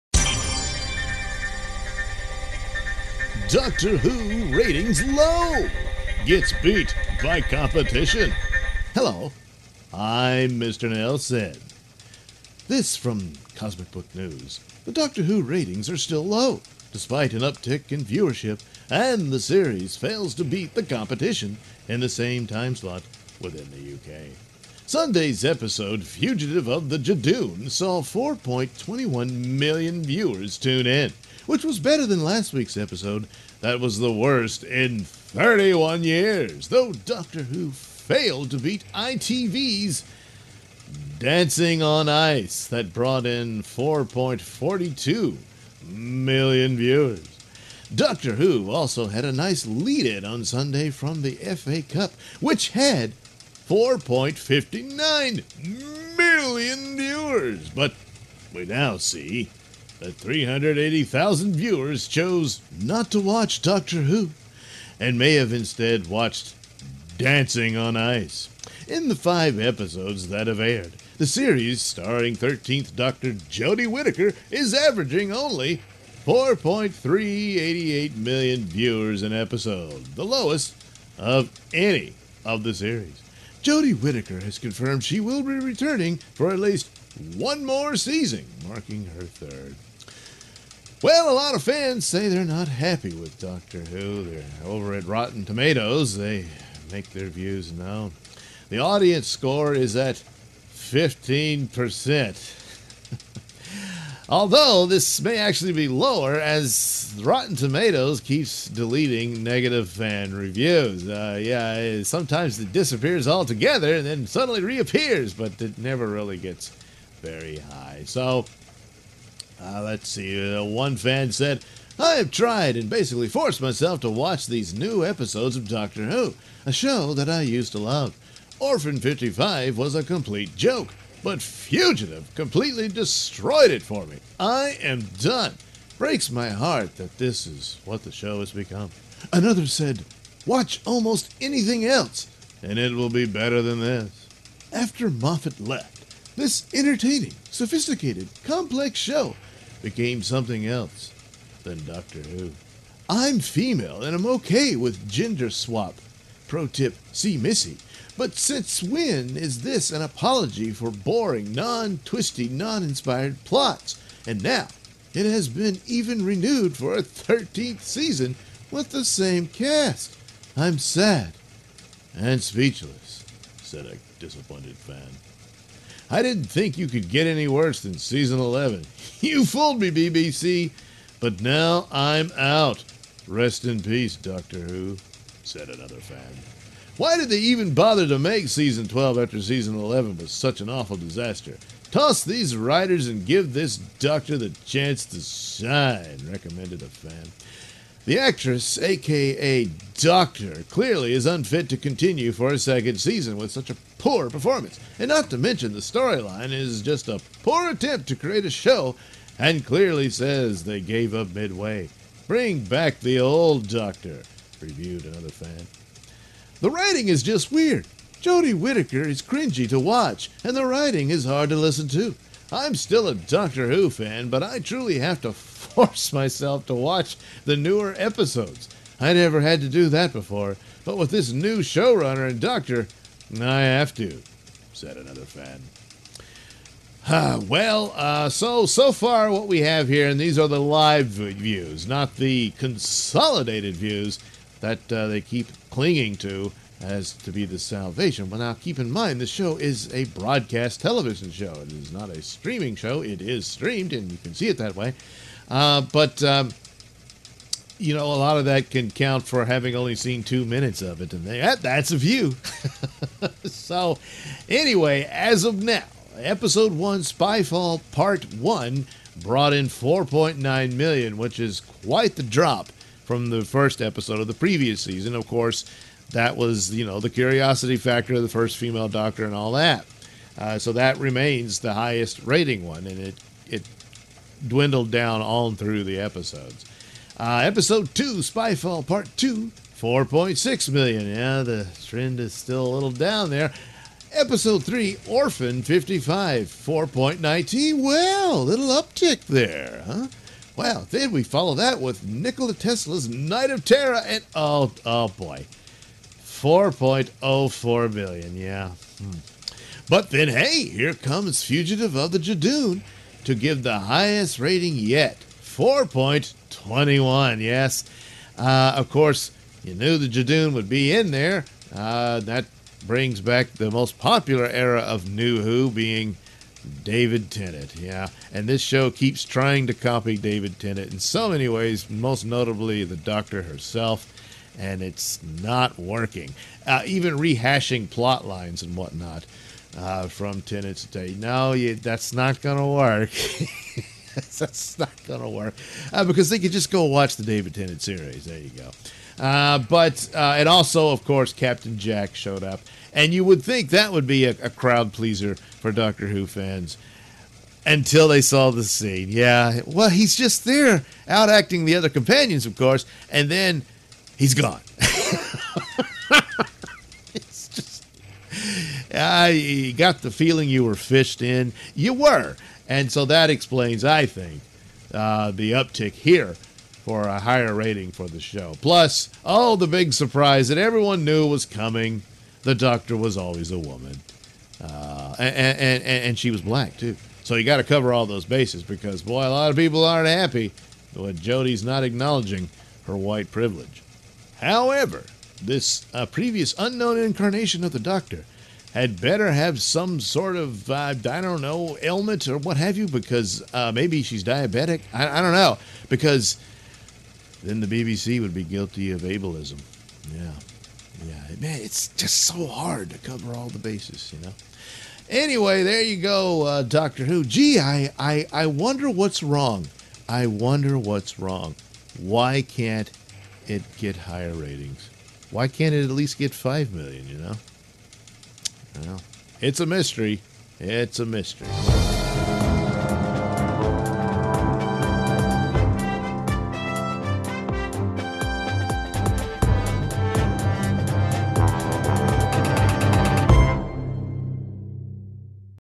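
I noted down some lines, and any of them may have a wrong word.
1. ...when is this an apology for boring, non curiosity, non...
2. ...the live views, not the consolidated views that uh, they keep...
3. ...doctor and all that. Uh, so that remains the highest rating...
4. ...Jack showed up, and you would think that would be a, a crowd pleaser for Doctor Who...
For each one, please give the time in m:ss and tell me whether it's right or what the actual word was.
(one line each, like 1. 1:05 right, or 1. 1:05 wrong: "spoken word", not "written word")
1. 2:38 wrong: "twisty", not "curiosity"
2. 4:00 right
3. 4:38 right
4. 5:51 right.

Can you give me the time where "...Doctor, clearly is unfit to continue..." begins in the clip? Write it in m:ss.
3:19.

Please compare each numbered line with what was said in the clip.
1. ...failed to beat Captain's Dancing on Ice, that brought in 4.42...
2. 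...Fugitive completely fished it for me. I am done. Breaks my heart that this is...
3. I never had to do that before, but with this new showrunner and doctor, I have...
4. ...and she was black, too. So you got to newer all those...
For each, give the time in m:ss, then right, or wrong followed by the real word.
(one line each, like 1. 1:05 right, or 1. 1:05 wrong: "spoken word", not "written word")
1. 0:37 wrong: "ITV", not "Captain"
2. 2:11 wrong: "destroyed", not "fished"
3. 3:48 right
4. 6:25 wrong: "cover", not "newer".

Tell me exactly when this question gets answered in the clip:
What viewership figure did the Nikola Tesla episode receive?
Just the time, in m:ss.
5:06.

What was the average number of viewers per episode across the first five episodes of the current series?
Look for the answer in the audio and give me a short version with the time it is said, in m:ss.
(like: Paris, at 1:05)
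4.388 million, at 1:16.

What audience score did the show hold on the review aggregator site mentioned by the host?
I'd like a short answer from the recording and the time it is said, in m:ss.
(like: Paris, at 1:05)
15%, at 1:40.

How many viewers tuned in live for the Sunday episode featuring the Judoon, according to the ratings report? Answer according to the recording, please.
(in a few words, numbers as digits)
4.21 million.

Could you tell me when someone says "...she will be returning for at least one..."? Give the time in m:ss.
1:25.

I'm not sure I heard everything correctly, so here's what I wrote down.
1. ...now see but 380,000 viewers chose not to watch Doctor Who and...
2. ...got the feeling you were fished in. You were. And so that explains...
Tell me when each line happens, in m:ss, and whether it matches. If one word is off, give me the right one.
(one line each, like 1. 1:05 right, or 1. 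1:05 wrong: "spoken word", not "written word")
1. 0:58 right
2. 6:09 right.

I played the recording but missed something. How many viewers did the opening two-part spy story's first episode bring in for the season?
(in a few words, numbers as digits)
4.9 million.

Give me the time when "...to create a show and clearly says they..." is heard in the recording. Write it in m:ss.
3:28.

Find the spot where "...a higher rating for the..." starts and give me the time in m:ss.
6:17.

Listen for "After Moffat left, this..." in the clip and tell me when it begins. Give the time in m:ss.
2:24.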